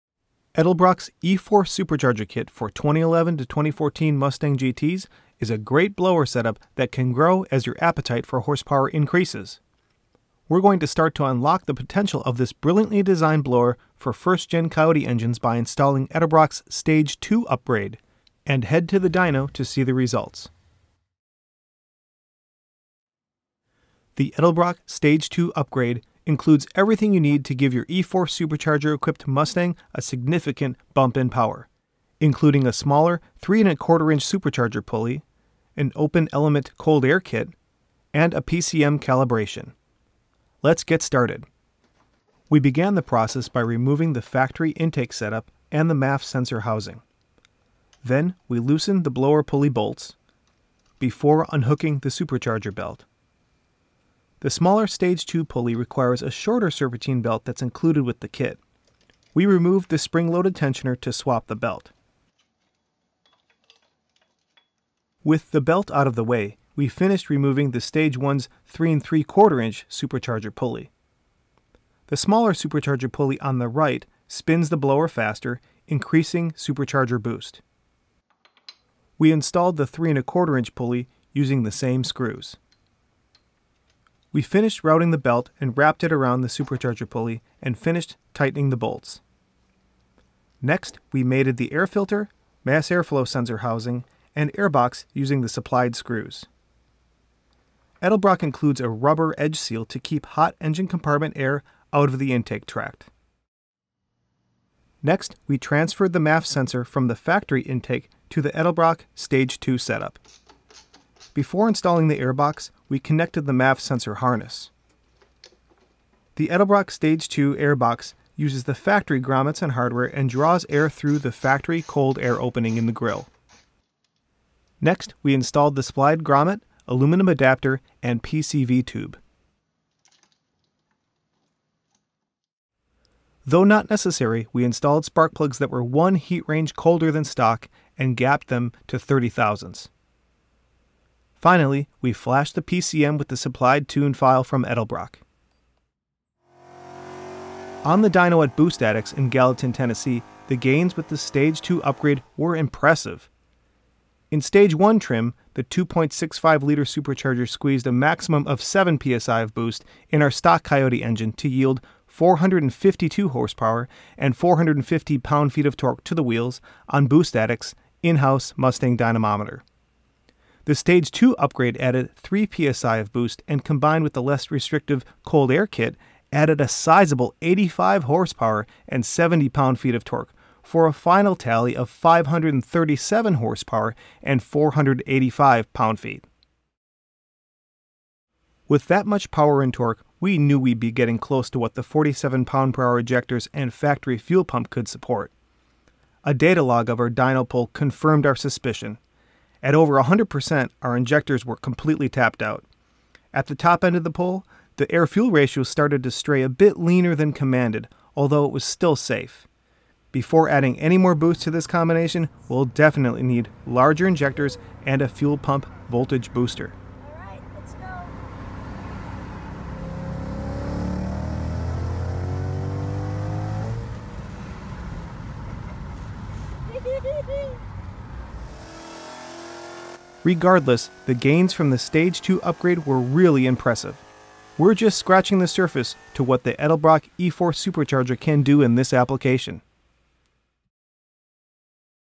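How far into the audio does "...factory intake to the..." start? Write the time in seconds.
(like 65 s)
107 s.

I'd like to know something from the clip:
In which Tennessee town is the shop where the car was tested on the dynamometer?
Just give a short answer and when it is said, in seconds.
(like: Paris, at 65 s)
Gallatin, at 149 s.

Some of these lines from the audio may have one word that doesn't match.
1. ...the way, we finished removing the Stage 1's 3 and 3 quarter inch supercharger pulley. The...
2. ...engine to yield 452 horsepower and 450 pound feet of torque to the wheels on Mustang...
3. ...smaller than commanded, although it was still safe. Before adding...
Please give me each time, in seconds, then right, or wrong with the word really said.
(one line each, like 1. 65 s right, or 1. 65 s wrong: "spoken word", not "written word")
1. 66 s right
2. 161 s wrong: "Boost", not "Mustang"
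3. 206 s wrong: "leaner", not "smaller".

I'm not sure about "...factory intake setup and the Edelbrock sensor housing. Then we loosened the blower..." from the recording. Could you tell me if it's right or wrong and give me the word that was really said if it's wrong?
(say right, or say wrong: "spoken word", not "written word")
wrong: "MAF", not "Edelbrock".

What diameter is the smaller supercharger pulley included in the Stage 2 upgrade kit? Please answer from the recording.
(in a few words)
3 1/4 inch.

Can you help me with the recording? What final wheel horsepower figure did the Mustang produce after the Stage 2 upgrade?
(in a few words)
537.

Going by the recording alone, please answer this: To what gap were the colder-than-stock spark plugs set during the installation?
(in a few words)
30 thousandths.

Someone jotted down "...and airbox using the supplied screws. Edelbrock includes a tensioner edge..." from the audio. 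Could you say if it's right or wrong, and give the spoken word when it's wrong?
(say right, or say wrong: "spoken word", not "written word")
wrong: "rubber", not "tensioner".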